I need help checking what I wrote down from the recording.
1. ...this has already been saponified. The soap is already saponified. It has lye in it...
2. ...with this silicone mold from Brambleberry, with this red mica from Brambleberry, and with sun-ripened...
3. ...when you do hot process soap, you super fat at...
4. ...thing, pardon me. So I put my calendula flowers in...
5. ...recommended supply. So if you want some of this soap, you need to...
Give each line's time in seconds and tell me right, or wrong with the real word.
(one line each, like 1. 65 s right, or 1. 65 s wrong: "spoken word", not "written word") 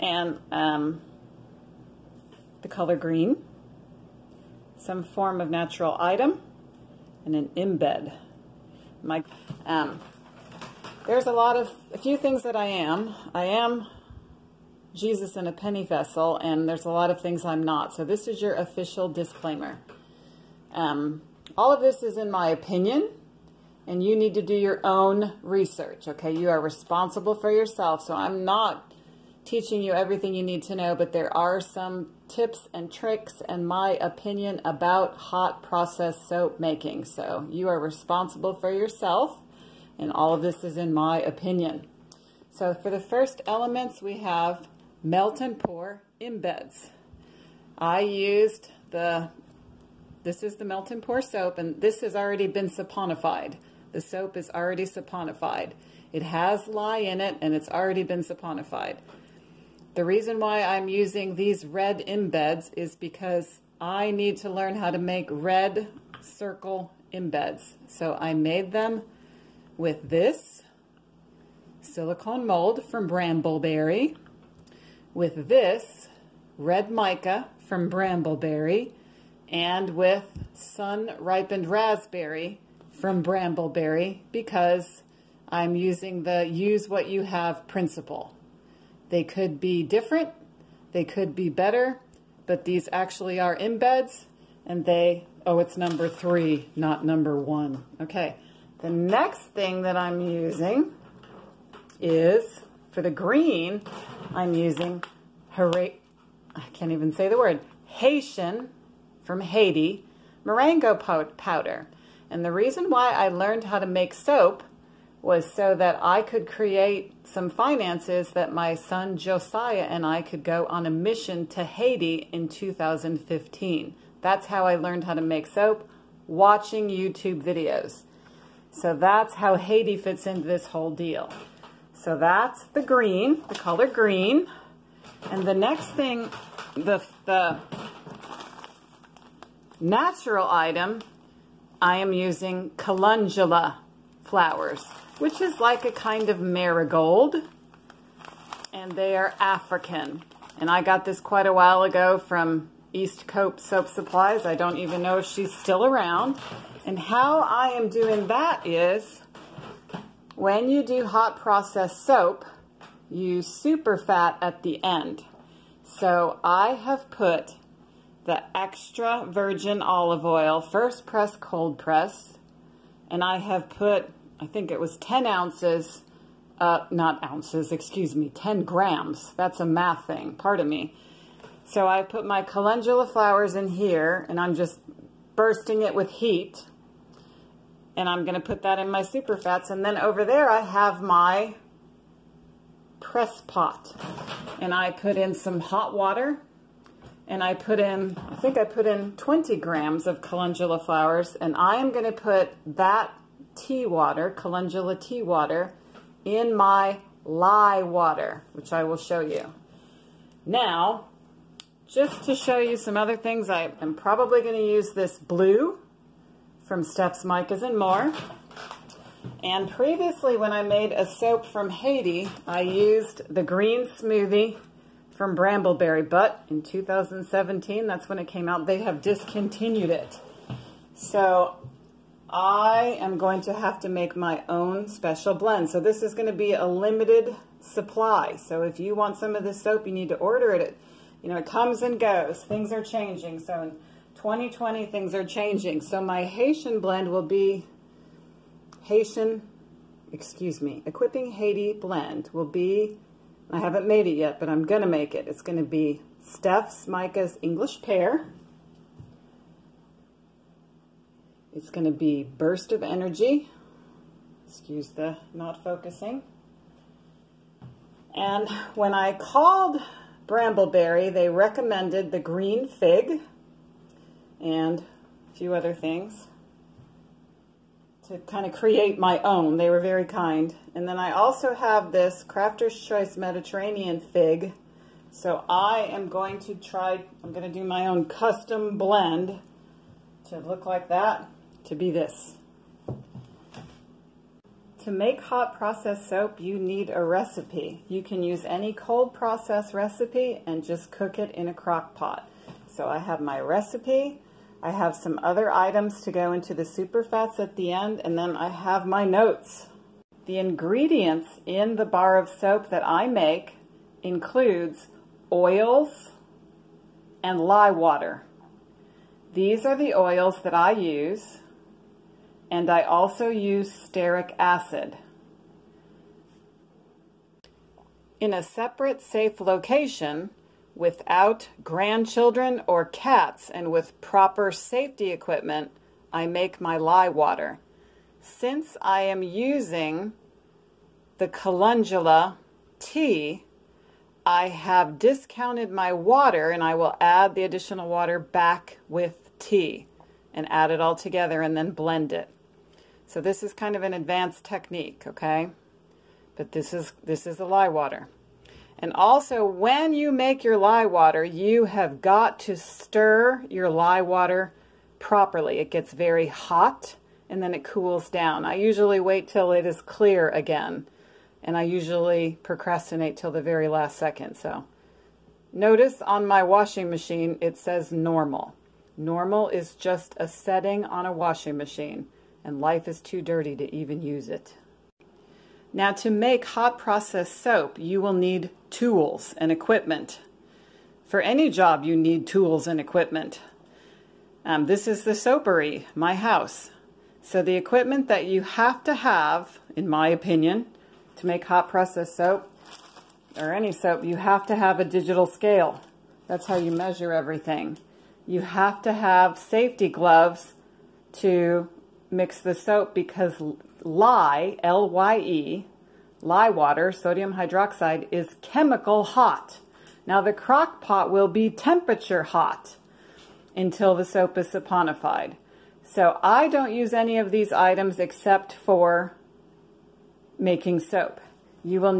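1. 51 s right
2. 69 s right
3. 160 s right
4. 180 s right
5. 236 s wrong: "limited", not "recommended".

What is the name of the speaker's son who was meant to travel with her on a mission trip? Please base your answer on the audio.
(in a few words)
Josiah.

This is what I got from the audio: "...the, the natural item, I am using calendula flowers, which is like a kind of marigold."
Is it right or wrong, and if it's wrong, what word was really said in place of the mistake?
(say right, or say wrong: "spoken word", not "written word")
right.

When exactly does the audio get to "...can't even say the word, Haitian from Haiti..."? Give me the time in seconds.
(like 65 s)
106 s.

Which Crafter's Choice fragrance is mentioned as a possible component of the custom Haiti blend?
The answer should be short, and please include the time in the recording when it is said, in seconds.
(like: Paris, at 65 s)
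Mediterranean fig, at 283 s.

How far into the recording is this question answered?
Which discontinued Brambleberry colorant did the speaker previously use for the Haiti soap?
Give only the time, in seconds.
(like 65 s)
223 s.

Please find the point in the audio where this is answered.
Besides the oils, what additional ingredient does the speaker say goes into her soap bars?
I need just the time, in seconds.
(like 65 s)
323 s.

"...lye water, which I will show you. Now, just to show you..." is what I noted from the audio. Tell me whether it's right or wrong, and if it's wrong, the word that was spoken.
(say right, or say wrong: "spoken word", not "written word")
right.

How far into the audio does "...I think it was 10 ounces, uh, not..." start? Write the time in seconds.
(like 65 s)
174 s.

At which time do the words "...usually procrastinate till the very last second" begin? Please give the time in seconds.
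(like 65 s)
371 s.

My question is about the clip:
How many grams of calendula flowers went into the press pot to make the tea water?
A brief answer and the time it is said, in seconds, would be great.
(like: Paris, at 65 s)
20 grams, at 199 s.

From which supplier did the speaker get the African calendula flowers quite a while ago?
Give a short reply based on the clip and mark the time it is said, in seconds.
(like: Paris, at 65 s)
East Cope Soap Supplies, at 152 s.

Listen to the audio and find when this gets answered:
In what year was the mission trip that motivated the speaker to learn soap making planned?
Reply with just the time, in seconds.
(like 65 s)
122 s.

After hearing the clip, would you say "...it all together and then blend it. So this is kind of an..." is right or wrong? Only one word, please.
right.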